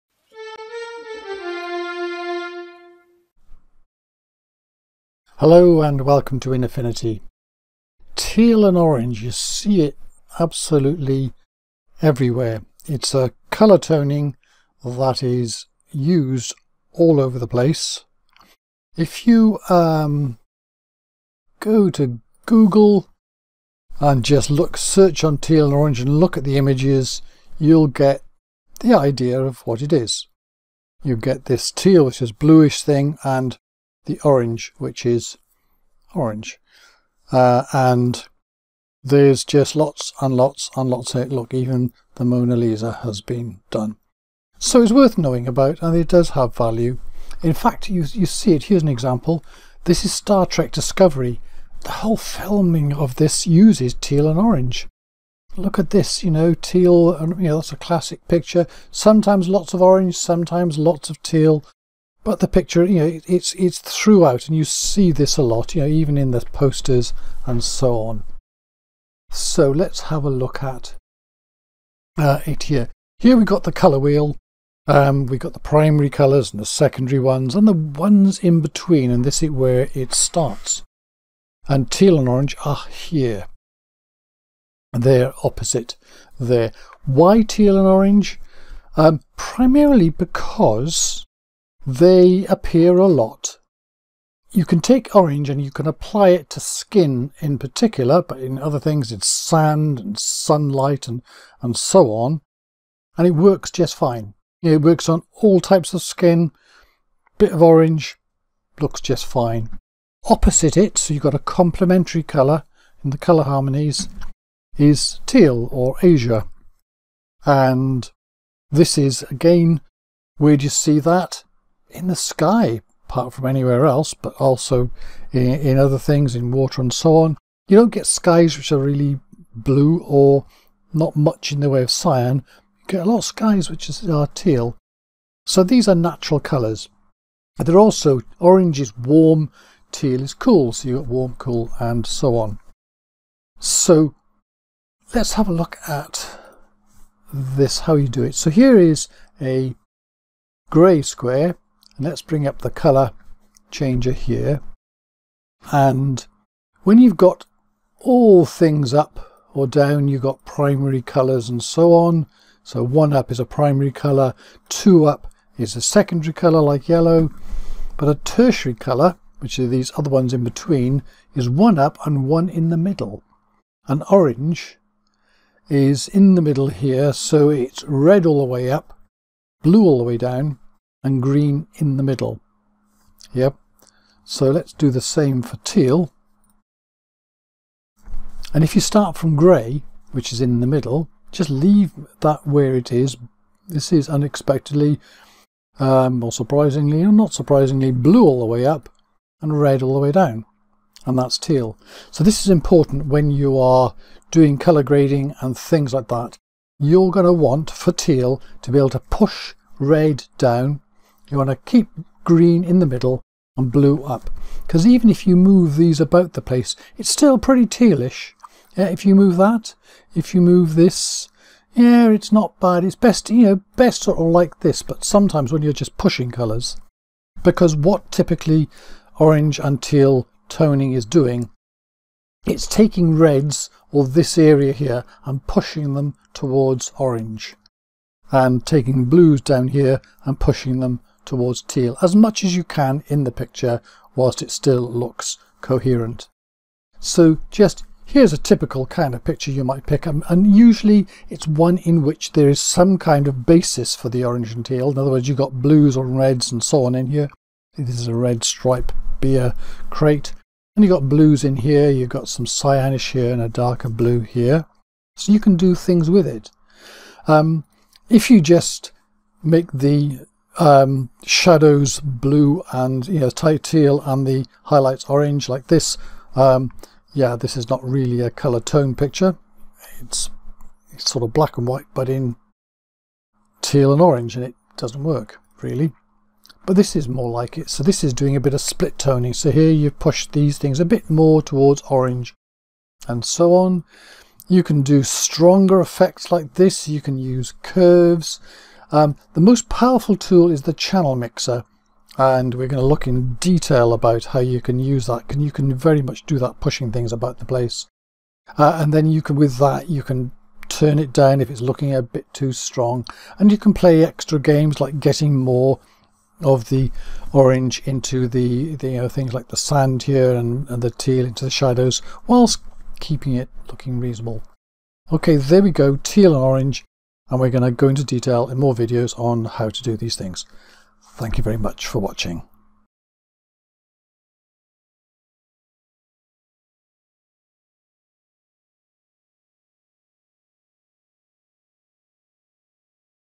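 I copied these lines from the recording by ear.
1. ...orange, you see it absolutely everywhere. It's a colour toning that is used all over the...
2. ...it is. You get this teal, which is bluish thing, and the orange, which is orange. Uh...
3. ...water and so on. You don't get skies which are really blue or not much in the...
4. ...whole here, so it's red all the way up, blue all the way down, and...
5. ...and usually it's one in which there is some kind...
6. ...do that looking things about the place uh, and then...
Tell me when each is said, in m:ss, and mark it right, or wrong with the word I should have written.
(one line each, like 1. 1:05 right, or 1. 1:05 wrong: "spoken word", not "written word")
1. 0:08 right
2. 0:29 right
3. 2:06 right
4. 2:56 wrong: "middle", not "whole"
5. 4:10 right
6. 5:06 wrong: "pushing", not "looking".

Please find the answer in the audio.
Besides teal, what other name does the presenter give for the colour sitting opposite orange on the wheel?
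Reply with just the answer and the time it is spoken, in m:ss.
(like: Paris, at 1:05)
azure, at 1:56.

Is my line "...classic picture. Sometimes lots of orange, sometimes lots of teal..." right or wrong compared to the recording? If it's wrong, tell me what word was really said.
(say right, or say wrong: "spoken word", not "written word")
right.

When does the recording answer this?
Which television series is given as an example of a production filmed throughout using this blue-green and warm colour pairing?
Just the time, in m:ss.
0:50.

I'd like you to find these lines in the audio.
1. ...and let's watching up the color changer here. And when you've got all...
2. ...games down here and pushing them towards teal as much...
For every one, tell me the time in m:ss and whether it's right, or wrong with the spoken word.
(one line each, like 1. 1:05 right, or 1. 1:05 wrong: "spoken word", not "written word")
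1. 2:31 wrong: "bring", not "watching"
2. 3:59 wrong: "blues", not "games".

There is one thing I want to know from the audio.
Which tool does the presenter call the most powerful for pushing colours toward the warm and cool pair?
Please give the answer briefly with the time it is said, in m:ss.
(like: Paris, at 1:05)
channel mixer, at 5:00.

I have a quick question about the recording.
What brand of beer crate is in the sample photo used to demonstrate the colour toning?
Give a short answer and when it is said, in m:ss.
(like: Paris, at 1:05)
Red Stripe, at 4:18.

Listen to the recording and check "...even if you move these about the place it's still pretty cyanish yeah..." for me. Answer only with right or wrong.
wrong.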